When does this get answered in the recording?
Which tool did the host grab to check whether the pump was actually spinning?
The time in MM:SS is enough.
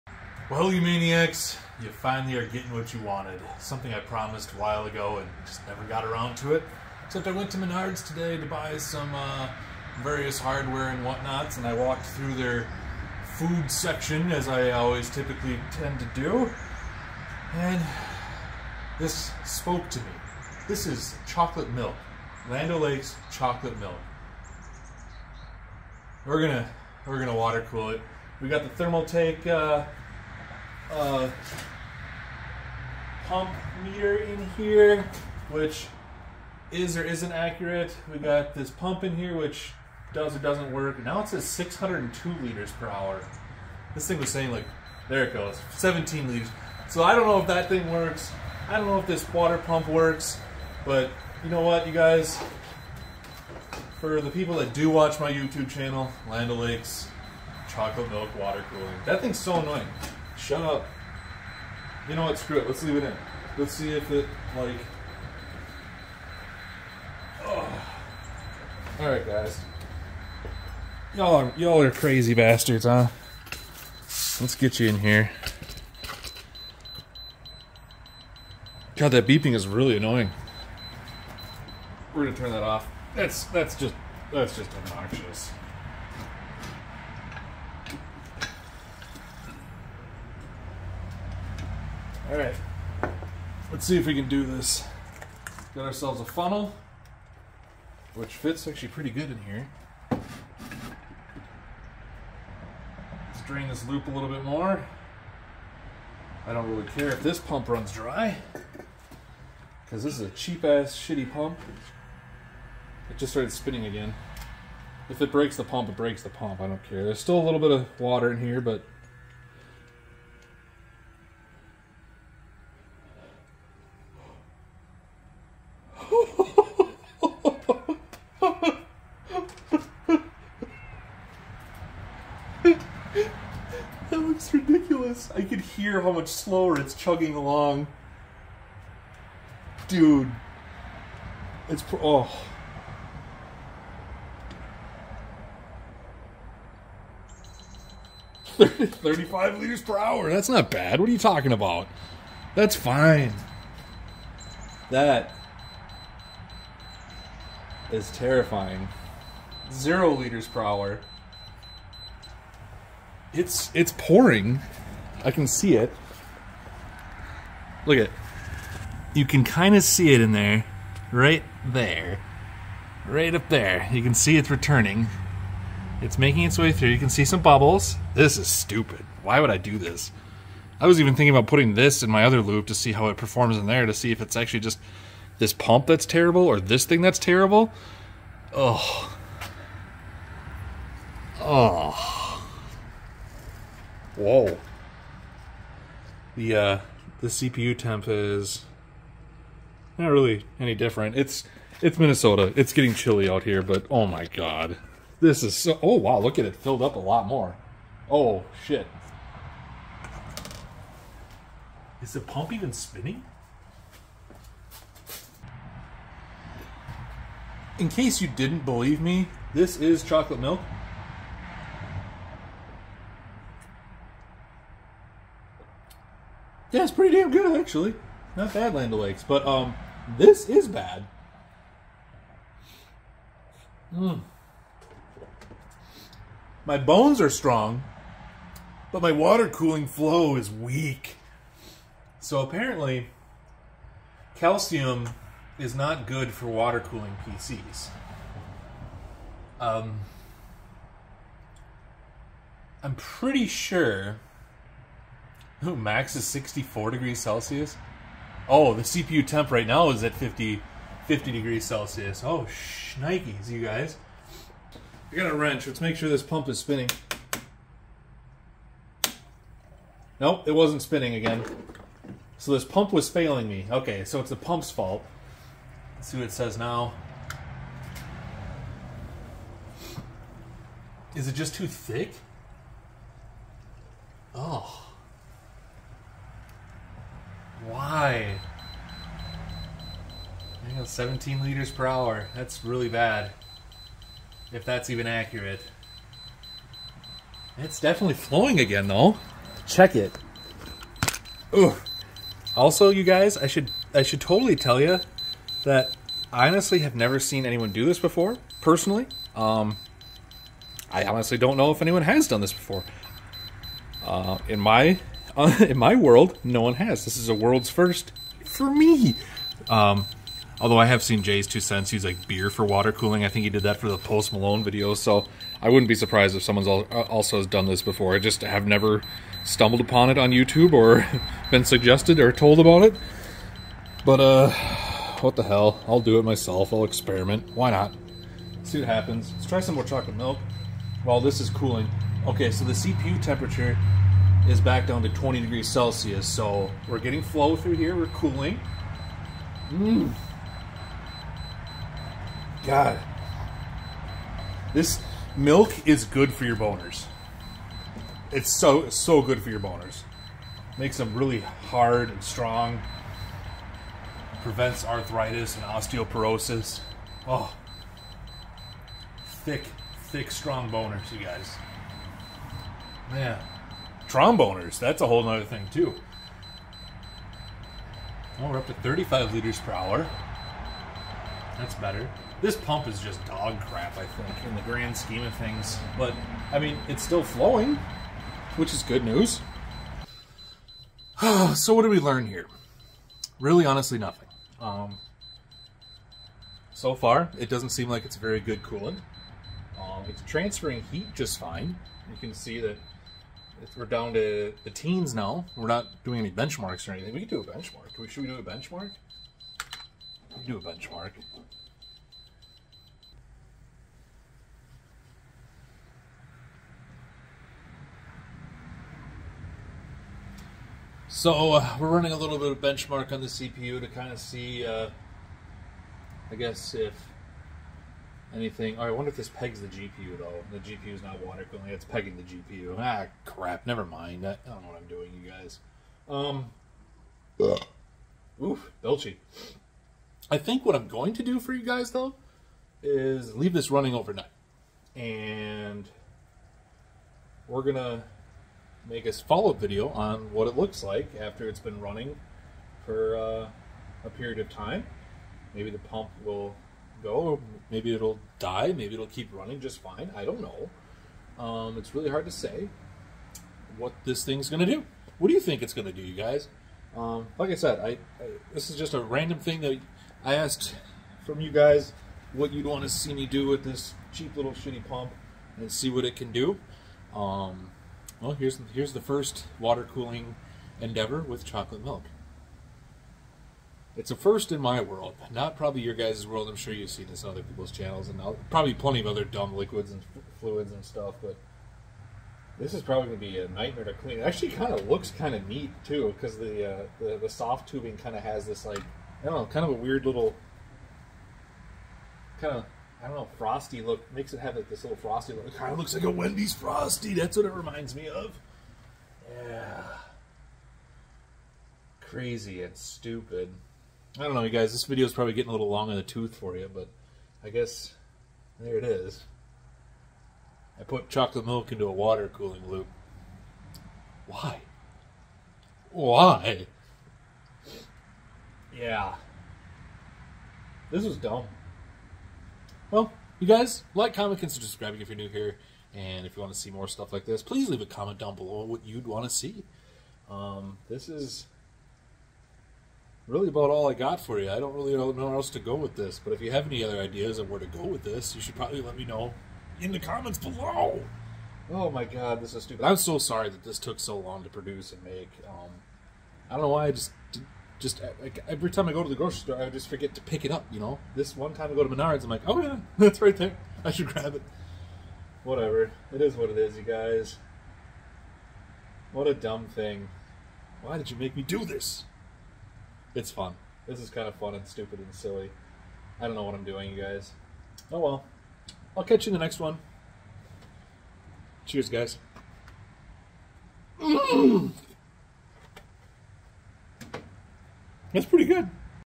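04:25.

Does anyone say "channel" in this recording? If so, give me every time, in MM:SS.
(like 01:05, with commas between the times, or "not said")
00:55, 08:07.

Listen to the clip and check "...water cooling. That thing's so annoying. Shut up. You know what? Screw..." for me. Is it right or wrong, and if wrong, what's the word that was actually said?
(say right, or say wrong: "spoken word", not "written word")
right.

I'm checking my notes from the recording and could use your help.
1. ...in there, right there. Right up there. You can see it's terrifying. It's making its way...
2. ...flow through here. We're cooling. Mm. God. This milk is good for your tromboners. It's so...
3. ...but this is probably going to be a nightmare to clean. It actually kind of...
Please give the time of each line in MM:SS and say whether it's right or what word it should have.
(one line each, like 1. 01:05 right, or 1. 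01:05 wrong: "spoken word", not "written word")
1. 02:50 wrong: "returning", not "terrifying"
2. 05:47 wrong: "boners", not "tromboners"
3. 08:11 right.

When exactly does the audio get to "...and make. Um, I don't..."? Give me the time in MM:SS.
09:14.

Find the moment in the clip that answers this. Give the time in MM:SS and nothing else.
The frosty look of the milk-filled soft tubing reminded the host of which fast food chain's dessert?
08:26.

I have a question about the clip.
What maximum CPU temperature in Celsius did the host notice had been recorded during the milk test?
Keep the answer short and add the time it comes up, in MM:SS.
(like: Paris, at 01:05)
64, at 04:16.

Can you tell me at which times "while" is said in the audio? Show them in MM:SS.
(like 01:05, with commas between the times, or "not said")
00:04, 05:41.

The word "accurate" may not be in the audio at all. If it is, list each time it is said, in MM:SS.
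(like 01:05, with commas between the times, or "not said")
00:37, 04:55.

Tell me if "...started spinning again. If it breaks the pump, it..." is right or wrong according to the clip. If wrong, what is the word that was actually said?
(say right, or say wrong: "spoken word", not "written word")
right.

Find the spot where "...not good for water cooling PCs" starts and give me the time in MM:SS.
04:05.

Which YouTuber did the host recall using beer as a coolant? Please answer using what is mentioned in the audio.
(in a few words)
JayzTwoCents.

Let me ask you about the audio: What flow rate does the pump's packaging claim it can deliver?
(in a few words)
602 liters per hour.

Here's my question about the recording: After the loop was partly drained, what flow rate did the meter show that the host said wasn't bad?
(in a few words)
35 liters per hour.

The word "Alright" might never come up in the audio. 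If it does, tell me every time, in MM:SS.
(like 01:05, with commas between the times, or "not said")
01:08, 01:32.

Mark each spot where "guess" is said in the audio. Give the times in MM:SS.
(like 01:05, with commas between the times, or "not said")
07:06, 08:37.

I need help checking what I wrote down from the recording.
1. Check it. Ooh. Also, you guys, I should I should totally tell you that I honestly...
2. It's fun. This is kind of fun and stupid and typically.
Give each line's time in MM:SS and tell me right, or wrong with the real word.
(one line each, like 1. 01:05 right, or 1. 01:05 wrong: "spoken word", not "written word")
1. 04:59 right
2. 09:33 wrong: "silly", not "typically".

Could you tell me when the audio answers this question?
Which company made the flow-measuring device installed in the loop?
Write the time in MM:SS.
00:28.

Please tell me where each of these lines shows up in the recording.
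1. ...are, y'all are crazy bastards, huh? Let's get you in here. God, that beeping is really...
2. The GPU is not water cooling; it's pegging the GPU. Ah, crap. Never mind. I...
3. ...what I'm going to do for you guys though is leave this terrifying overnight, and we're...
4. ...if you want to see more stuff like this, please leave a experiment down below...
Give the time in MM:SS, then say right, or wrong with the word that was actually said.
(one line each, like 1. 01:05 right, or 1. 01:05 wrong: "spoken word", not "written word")
1. 01:11 right
2. 07:10 right
3. 07:20 wrong: "running", not "terrifying"
4. 08:56 wrong: "comment", not "experiment".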